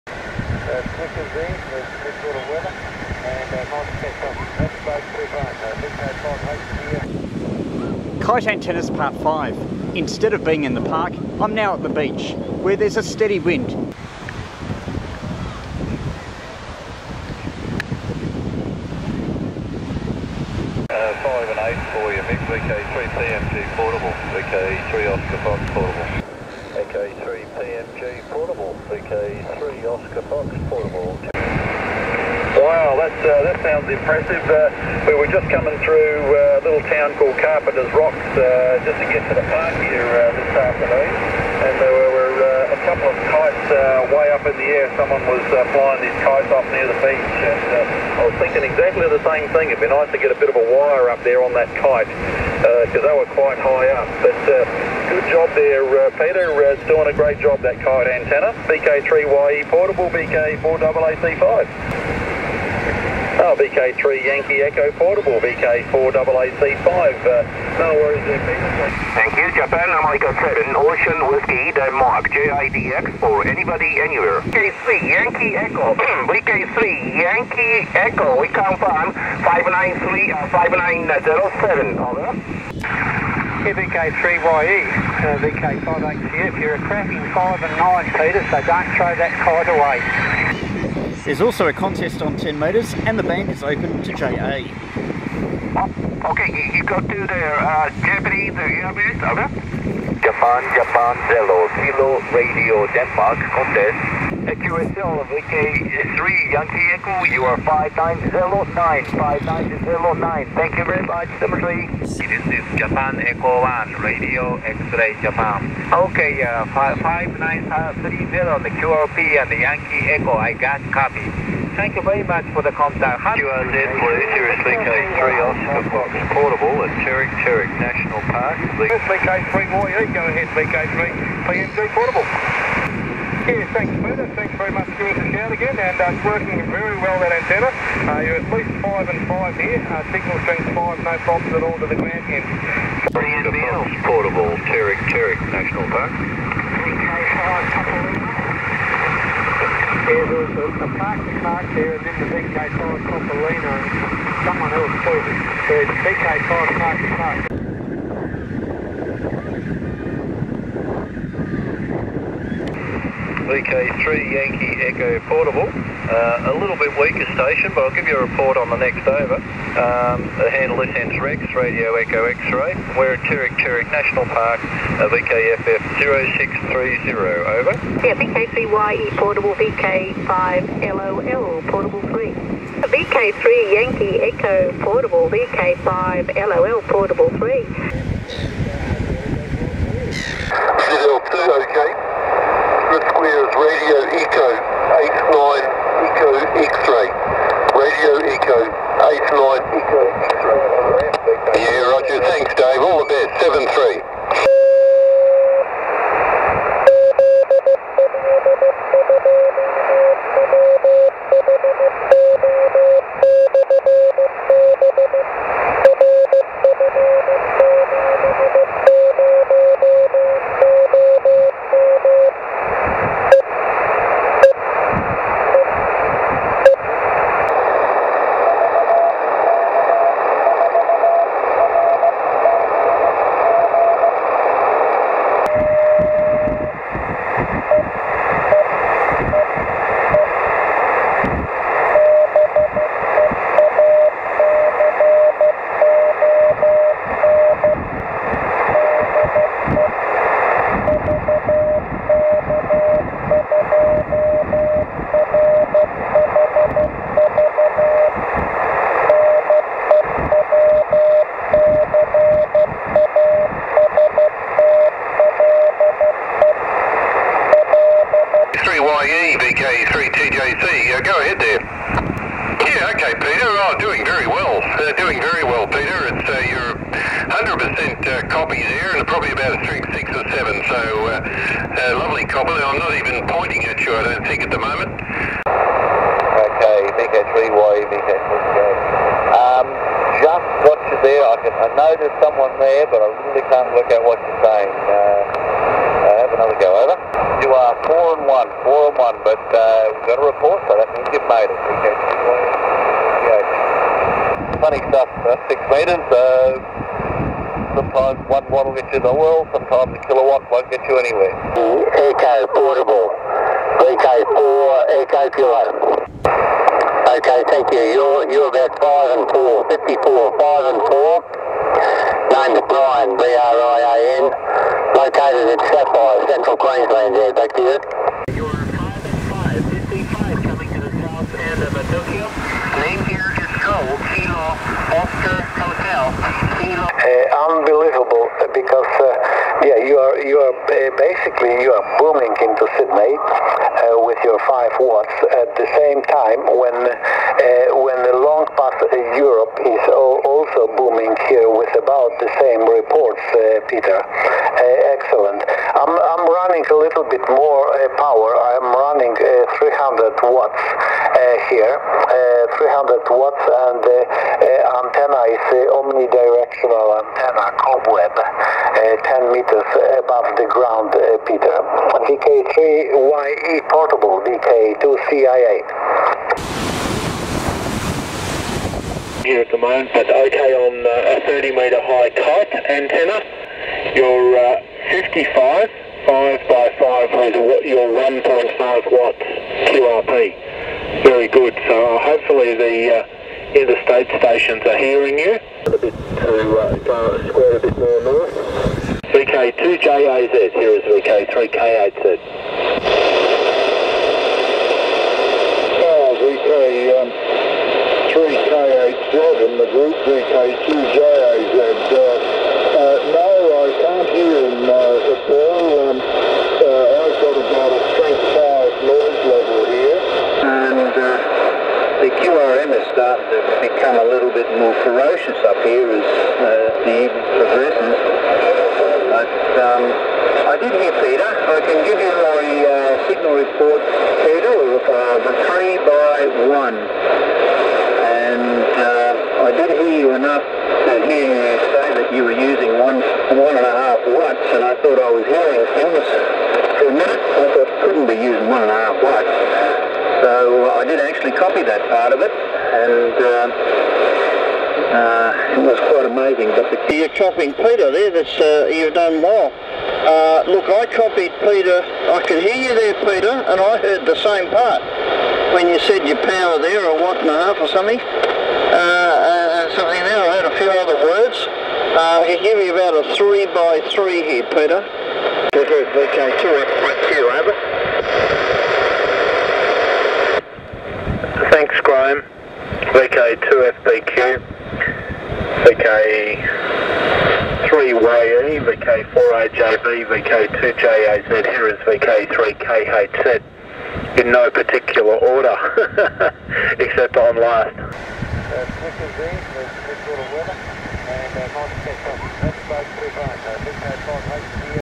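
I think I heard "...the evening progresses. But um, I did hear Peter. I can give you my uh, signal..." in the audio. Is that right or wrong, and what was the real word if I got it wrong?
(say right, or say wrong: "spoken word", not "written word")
right.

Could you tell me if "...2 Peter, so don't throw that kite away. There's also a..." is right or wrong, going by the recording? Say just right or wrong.
wrong.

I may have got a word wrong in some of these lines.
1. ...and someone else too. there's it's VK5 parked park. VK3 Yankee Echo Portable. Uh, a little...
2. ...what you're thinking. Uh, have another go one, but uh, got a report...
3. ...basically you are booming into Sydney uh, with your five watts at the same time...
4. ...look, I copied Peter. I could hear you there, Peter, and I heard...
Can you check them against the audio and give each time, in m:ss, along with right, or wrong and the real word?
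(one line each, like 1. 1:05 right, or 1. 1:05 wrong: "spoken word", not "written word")
1. 2:33 right
2. 4:54 wrong: "saying", not "thinking"
3. 5:41 right
4. 7:40 right.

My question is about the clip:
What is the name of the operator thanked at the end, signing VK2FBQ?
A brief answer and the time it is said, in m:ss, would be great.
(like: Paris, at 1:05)
Graham, at 8:01.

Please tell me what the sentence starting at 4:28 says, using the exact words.
YE vk 32 Uh, go ahead there.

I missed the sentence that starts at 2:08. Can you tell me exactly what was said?
VK3 Warrior, go ahead VK3, PNG Portable.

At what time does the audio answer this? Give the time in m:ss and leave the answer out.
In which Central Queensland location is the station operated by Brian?
5:25.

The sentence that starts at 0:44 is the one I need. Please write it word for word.
Someone was flying these kites off near the beach.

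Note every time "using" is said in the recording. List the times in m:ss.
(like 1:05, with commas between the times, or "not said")
7:22, 7:28.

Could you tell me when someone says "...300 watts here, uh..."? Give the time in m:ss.
5:59.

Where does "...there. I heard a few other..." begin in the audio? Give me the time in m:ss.
7:50.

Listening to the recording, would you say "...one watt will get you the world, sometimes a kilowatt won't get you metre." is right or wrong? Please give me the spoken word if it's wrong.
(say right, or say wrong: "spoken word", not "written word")
wrong: "anywhere", not "metre".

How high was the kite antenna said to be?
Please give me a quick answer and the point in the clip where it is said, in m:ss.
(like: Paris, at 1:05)
30 metres, at 6:21.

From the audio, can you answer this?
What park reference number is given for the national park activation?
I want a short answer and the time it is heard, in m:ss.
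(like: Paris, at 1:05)
VKFF 0630, at 2:55.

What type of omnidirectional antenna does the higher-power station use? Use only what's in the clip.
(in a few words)
cobweb.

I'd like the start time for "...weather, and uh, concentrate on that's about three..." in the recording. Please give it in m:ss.
0:02.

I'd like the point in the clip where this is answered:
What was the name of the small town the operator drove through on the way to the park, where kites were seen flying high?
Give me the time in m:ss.
0:37.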